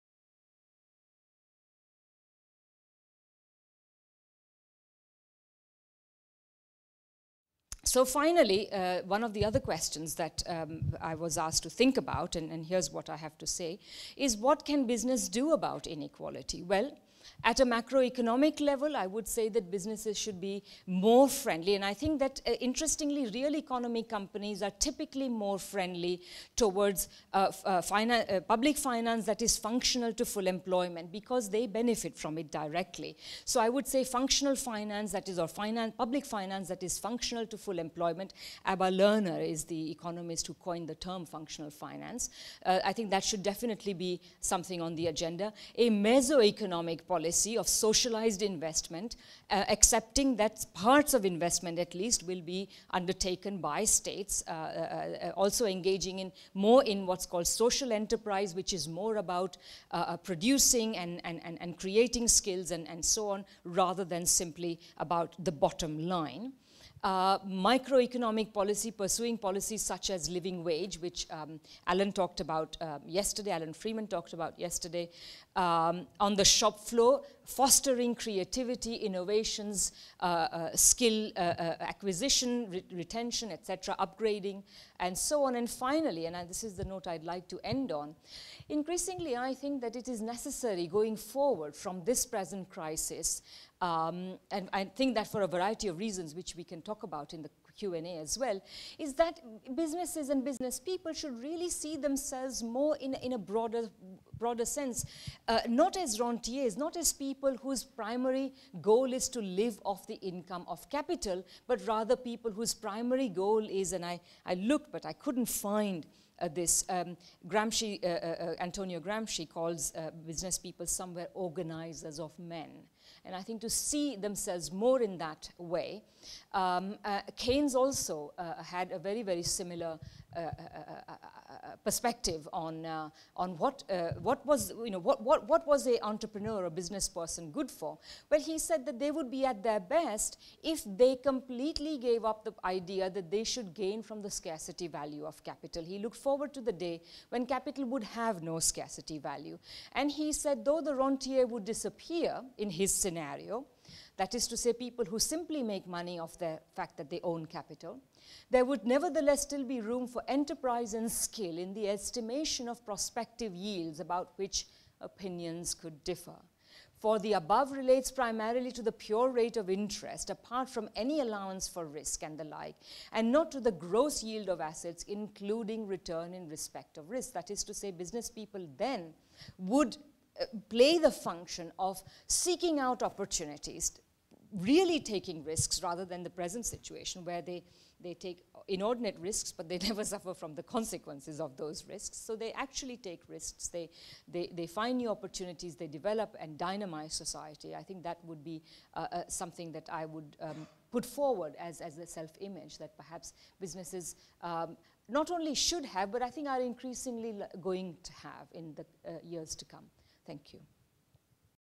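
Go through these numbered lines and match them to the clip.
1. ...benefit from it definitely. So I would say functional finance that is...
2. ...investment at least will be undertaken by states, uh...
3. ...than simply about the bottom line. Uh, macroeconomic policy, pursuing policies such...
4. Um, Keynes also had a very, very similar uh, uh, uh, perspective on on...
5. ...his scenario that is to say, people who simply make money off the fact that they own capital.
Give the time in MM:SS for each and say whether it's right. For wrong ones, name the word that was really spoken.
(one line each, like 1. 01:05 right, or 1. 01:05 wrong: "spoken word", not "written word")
1. 00:31 wrong: "directly", not "definitely"
2. 00:51 right
3. 01:04 wrong: "microeconomic", not "macroeconomic"
4. 02:06 right
5. 02:32 right.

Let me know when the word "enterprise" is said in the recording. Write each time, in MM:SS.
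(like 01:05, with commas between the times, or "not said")
00:58, 02:40.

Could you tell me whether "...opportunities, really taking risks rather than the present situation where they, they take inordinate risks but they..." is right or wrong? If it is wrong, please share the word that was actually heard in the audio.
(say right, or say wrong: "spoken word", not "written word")
right.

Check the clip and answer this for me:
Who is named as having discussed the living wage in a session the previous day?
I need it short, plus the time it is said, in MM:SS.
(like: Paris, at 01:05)
Alan Freeman, at 01:13.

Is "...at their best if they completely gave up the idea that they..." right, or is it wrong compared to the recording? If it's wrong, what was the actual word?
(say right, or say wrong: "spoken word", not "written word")
right.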